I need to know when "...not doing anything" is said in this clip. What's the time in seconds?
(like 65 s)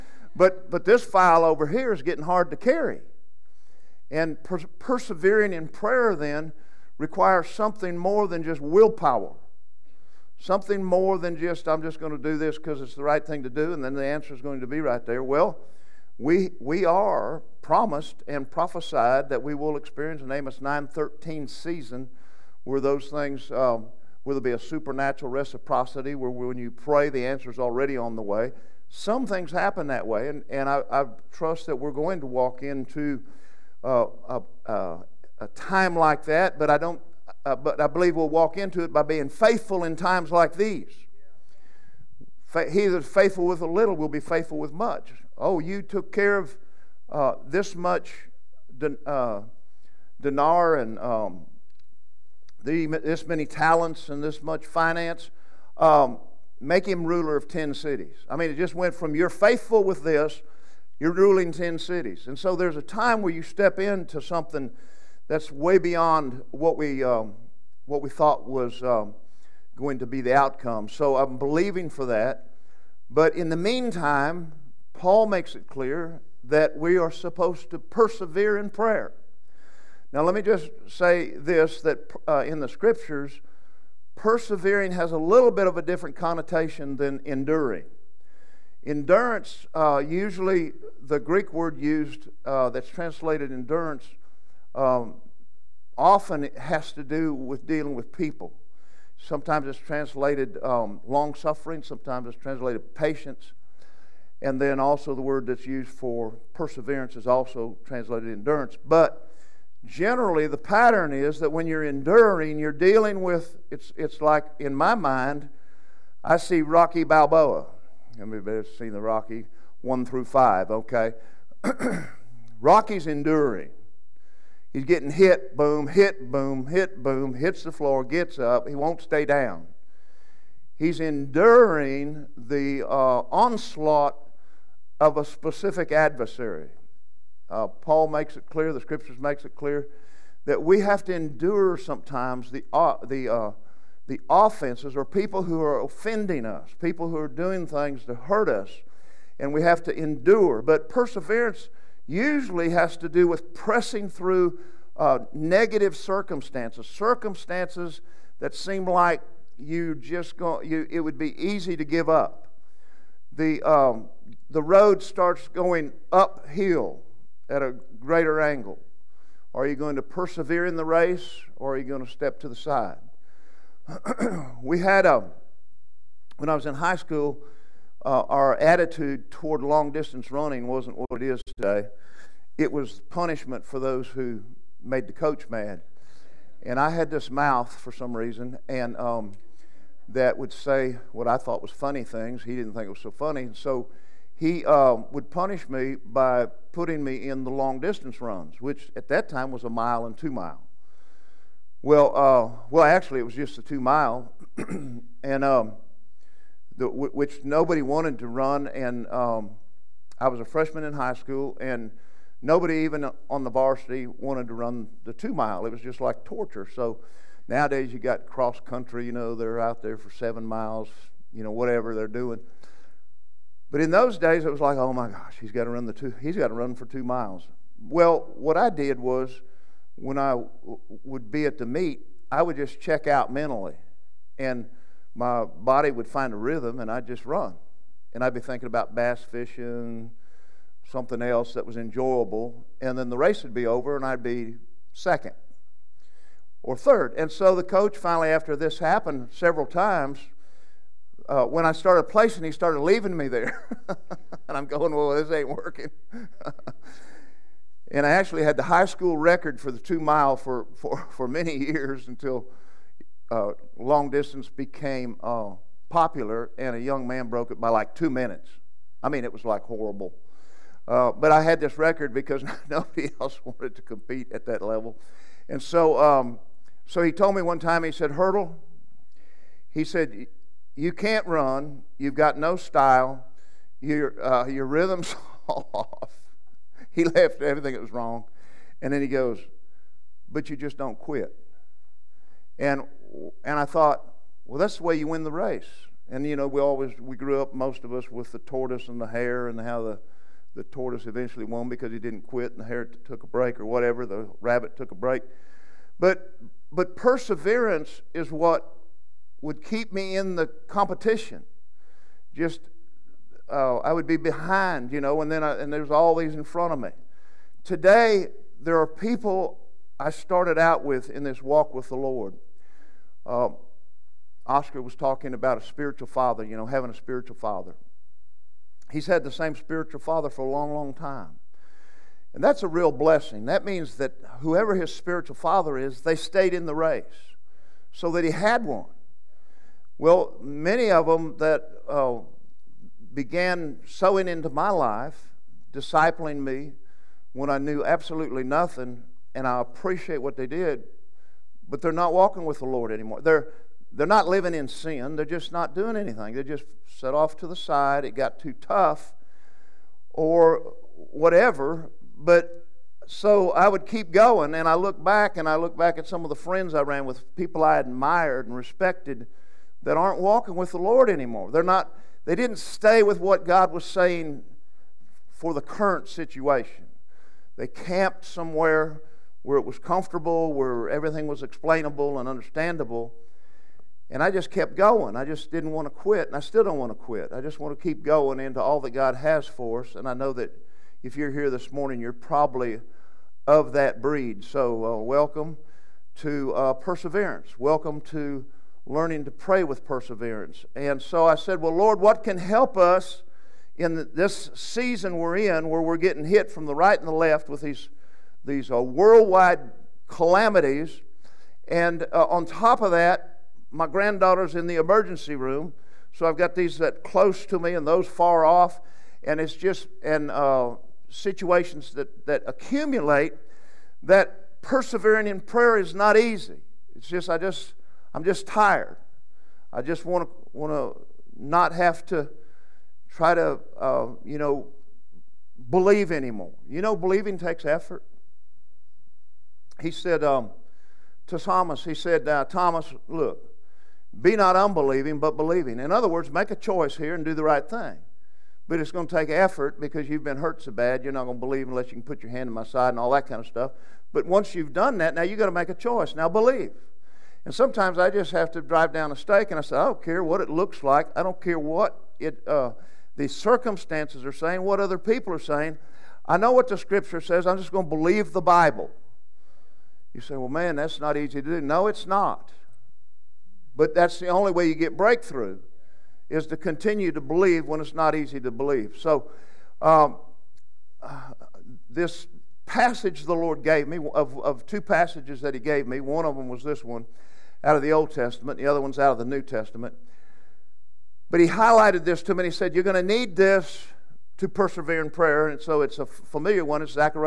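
355 s.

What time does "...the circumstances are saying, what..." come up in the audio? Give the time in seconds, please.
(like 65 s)
463 s.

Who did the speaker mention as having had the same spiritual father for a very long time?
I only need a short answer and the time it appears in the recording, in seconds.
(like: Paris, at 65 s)
Oscar, at 324 s.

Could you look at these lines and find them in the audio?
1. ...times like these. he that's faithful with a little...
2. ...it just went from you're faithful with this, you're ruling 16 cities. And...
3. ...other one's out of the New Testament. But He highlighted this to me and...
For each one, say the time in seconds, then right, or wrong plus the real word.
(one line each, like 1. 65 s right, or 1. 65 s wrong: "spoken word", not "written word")
1. 39 s right
2. 58 s wrong: "10", not "16"
3. 488 s right.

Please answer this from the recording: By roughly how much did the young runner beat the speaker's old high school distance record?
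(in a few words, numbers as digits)
Two minutes.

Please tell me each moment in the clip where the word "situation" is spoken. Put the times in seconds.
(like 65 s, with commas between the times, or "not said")
376 s, 421 s.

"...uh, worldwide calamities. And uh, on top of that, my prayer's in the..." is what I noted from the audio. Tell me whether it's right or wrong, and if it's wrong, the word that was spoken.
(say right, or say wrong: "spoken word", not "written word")
wrong: "granddaughter", not "prayer".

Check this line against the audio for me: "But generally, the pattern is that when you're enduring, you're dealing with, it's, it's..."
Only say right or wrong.
right.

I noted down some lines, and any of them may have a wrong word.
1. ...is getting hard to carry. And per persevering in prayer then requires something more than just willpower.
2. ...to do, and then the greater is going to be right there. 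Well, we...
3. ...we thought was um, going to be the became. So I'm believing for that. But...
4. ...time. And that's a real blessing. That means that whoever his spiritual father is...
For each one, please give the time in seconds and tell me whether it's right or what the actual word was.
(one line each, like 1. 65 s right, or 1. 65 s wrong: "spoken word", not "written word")
1. 1 s right
2. 13 s wrong: "answer", not "greater"
3. 68 s wrong: "outcome", not "became"
4. 330 s right.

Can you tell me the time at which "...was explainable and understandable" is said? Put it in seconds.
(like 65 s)
381 s.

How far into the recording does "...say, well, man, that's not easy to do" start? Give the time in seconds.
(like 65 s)
470 s.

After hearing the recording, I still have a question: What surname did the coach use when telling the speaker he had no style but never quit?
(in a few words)
Hertel.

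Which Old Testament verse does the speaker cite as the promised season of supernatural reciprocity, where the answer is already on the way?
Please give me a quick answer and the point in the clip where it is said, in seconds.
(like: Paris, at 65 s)
Amos 9:13, at 20 s.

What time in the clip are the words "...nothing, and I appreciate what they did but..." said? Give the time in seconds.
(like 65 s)
348 s.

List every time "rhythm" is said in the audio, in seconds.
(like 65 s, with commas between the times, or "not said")
236 s, 284 s.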